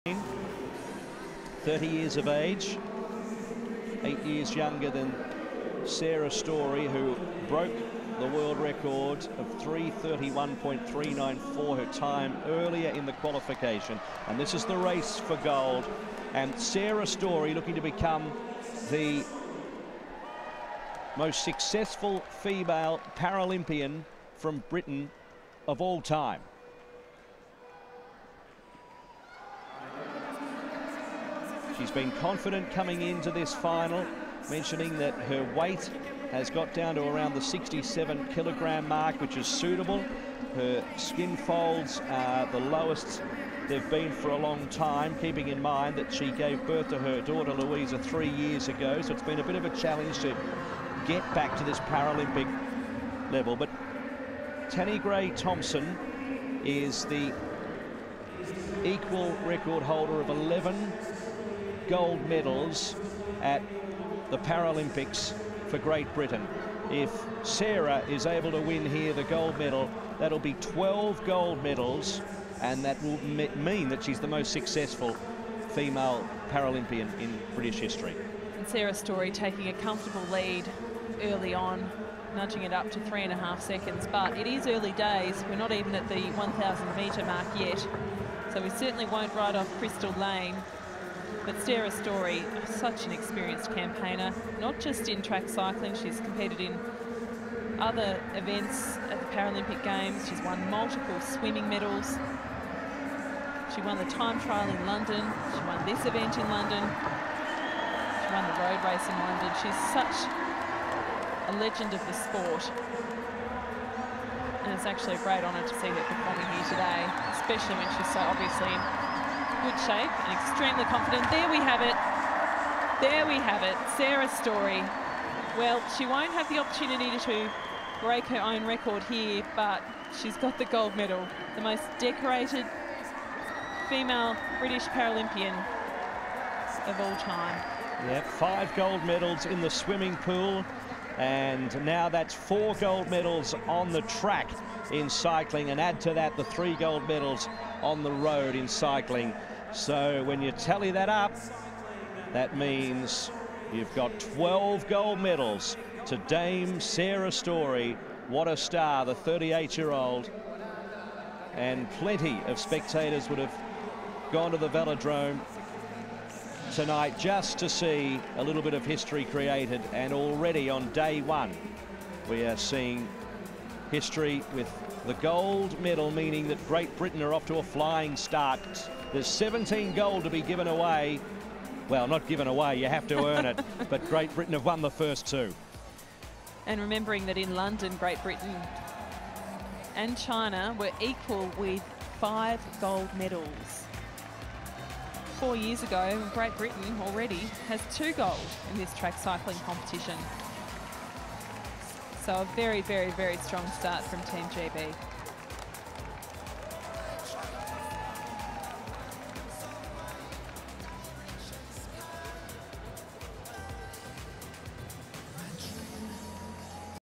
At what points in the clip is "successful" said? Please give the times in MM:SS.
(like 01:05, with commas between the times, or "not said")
00:21, 01:14.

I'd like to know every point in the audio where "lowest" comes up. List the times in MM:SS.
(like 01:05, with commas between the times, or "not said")
00:42.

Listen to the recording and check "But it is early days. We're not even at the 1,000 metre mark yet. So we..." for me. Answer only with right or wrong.
right.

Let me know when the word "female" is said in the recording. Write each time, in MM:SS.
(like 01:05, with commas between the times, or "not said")
00:22, 01:15, 02:13.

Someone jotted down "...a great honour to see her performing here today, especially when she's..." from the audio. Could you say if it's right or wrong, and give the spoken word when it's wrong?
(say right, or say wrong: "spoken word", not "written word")
right.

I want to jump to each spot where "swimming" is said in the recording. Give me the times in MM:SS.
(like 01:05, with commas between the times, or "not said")
01:41, 02:19.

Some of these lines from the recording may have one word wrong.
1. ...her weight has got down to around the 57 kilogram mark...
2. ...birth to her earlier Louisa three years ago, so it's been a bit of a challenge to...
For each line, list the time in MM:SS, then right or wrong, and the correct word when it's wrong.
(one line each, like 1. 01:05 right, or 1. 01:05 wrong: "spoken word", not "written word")
1. 00:35 wrong: "67", not "57"
2. 00:46 wrong: "daughter", not "earlier".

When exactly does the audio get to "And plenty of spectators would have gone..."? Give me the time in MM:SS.
02:41.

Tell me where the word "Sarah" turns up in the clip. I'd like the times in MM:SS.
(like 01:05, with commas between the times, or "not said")
00:05, 00:16, 01:07, 01:18, 01:31, 02:03, 02:36.